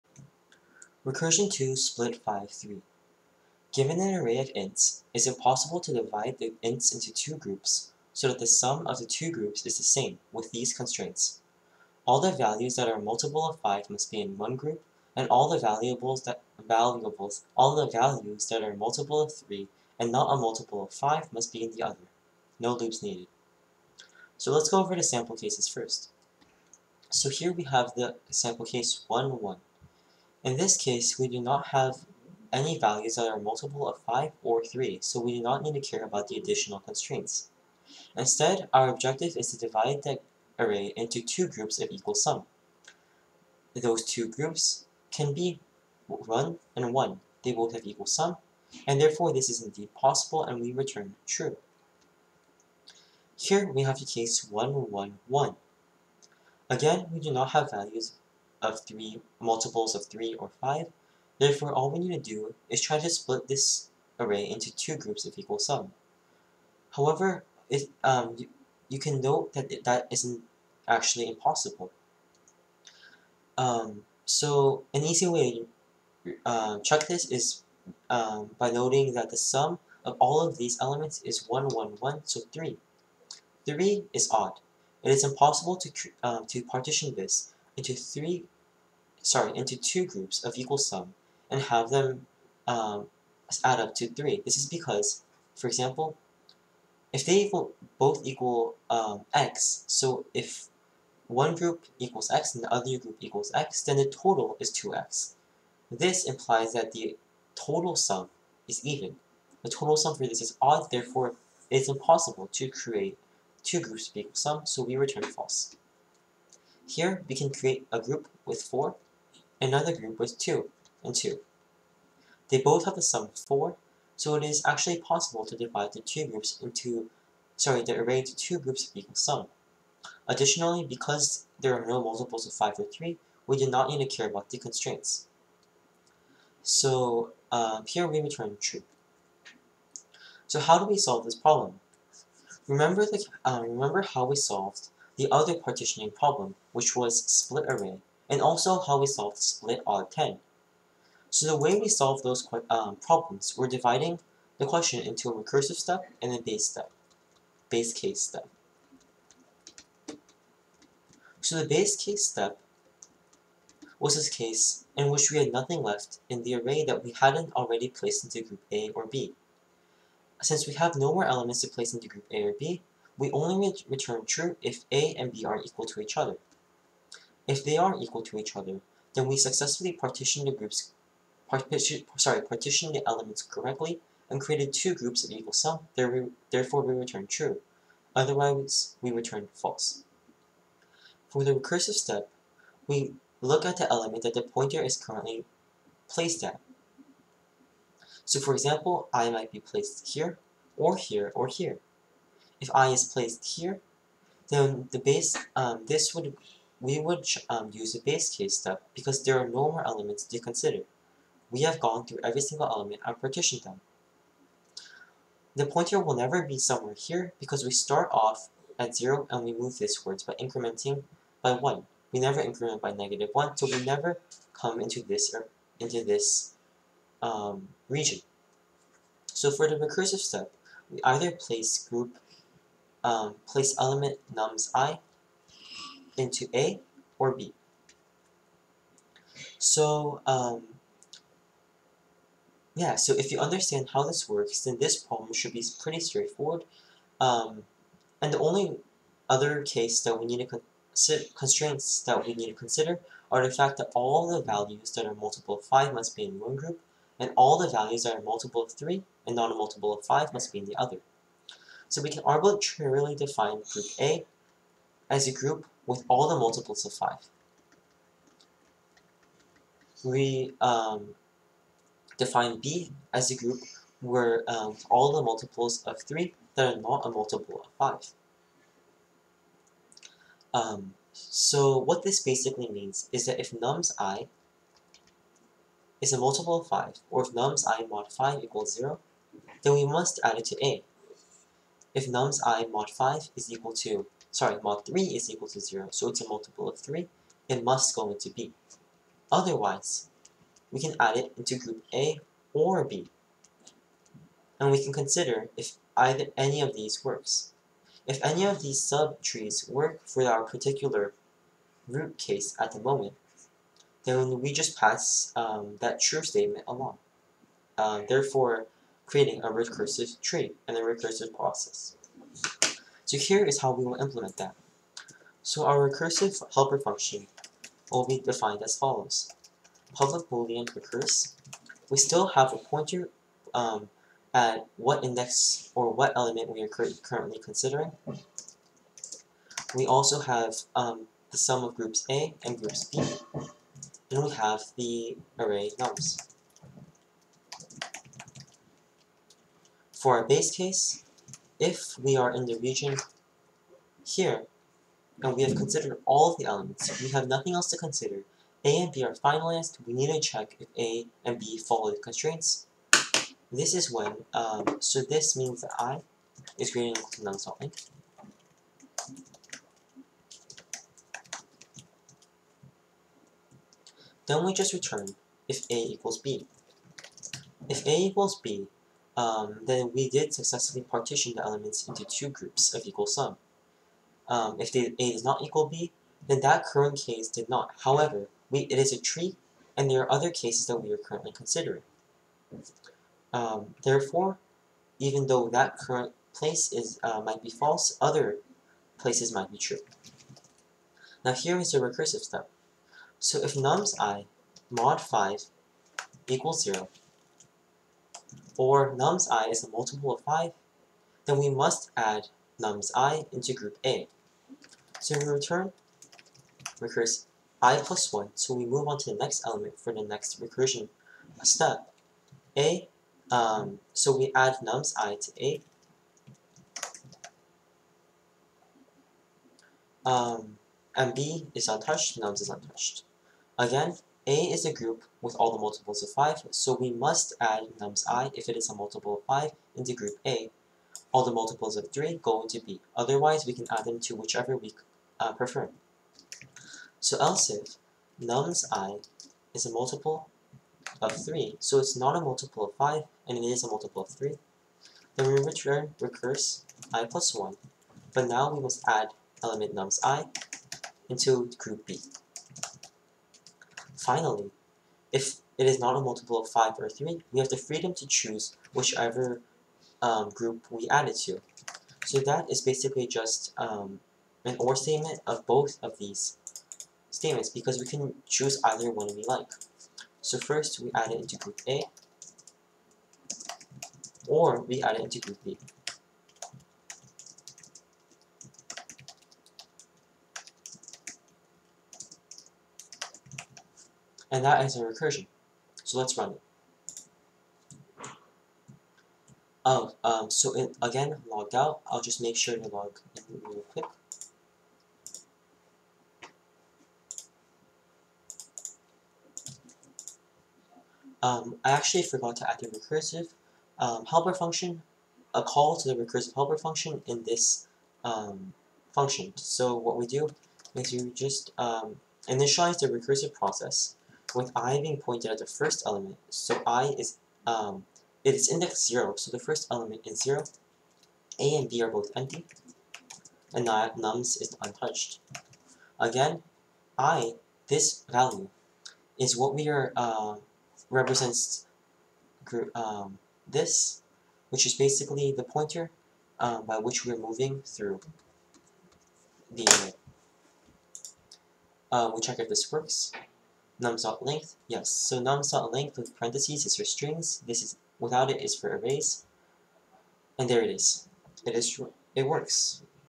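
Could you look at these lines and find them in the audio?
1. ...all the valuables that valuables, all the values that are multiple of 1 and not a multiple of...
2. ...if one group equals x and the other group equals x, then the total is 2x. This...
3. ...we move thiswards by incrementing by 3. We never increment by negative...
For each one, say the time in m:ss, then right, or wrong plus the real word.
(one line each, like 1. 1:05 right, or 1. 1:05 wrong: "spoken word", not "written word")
1. 0:15 wrong: "3", not "1"
2. 1:40 right
3. 3:39 wrong: "1", not "3".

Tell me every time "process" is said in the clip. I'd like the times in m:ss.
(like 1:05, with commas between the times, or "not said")
5:21, 8:43.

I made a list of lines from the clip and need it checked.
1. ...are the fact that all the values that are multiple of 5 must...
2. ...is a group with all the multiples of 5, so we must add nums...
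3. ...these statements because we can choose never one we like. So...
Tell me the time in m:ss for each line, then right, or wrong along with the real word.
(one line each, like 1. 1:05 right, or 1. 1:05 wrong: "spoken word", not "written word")
1. 4:13 right
2. 7:14 right
3. 7:55 wrong: "either", not "never".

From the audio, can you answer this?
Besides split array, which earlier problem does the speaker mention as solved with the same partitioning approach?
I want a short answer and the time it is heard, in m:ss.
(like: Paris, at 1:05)
split odd 10, at 2:29.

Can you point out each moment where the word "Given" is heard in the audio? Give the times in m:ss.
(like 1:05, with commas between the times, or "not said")
0:03.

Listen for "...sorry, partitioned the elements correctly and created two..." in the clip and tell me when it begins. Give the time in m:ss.
3:02.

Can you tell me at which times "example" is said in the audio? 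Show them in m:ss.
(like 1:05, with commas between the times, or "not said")
1:35, 3:18.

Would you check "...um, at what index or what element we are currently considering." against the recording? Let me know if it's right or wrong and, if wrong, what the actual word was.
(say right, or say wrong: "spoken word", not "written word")
right.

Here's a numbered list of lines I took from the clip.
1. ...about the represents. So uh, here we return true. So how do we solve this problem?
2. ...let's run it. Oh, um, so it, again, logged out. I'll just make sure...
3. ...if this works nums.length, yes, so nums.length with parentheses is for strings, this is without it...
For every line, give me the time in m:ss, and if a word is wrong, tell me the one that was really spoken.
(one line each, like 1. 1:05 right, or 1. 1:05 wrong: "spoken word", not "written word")
1. 2:14 wrong: "constraints", not "represents"
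2. 8:15 right
3. 9:12 right.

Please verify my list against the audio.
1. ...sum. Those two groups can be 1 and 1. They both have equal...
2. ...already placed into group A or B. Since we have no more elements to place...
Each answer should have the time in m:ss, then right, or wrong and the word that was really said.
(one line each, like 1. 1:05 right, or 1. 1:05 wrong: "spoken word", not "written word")
1. 0:42 right
2. 2:47 right.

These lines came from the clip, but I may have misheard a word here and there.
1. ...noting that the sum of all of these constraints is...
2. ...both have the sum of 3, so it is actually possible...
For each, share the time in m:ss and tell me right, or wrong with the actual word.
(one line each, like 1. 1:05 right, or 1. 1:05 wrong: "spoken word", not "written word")
1. 1:18 wrong: "elements", not "constraints"
2. 2:02 wrong: "4", not "3".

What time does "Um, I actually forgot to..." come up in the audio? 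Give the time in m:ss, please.
8:31.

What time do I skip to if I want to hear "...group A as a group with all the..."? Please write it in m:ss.
4:23.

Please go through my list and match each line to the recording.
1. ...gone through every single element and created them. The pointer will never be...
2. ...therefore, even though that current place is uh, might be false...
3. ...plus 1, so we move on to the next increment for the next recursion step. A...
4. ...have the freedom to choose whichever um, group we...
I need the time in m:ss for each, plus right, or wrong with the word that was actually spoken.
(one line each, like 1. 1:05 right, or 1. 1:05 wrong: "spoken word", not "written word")
1. 3:31 wrong: "partitioned", not "created"
2. 6:33 right
3. 6:57 wrong: "element", not "increment"
4. 7:47 right.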